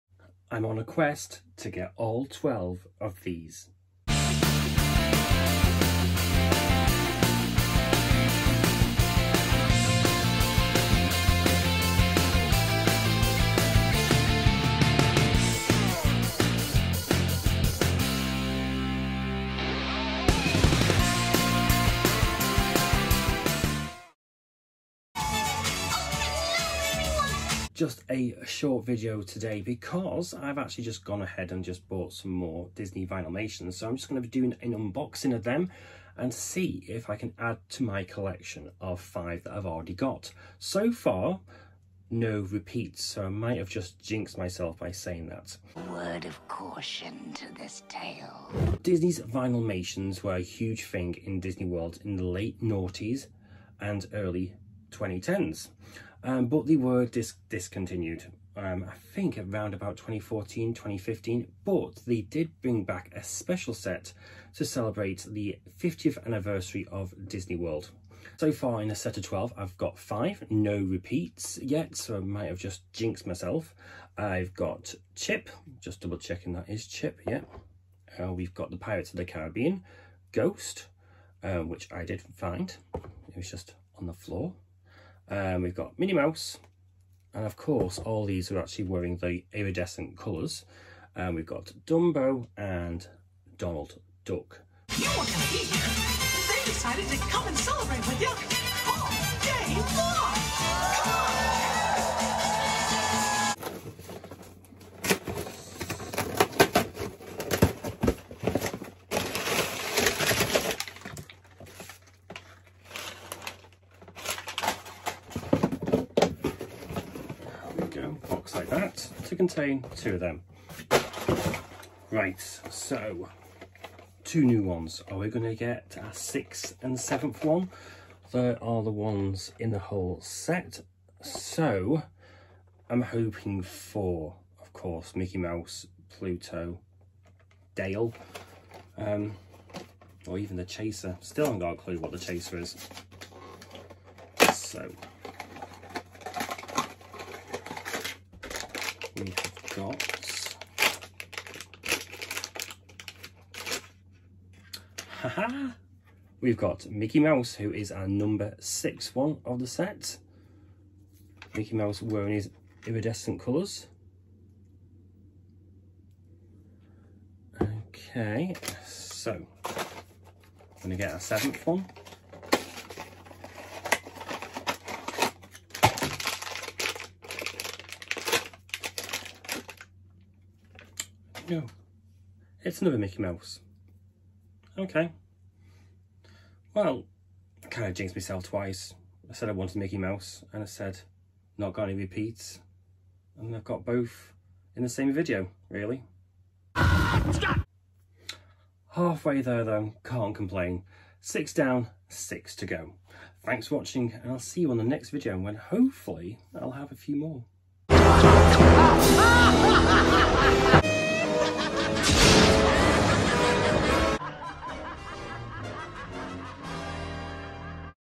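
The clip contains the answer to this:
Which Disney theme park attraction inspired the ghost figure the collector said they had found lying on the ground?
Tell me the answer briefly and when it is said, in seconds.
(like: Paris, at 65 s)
Pirates of the Caribbean, at 78 s.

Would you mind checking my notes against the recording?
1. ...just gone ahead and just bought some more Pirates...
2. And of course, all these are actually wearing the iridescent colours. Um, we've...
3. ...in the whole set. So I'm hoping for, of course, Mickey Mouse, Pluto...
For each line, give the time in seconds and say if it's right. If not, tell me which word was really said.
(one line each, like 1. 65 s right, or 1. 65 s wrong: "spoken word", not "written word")
1. 30 s wrong: "Disney", not "Pirates"
2. 87 s right
3. 129 s right.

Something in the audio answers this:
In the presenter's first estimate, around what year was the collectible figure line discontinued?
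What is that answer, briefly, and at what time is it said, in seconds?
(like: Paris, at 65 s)
2014, at 59 s.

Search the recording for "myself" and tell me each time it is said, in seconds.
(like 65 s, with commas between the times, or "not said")
44 s, 73 s, 188 s.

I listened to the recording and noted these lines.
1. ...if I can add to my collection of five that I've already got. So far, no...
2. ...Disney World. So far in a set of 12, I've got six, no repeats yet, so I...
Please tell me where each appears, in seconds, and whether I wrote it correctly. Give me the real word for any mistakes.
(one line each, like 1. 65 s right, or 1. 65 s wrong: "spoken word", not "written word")
1. 36 s right
2. 67 s wrong: "five", not "six".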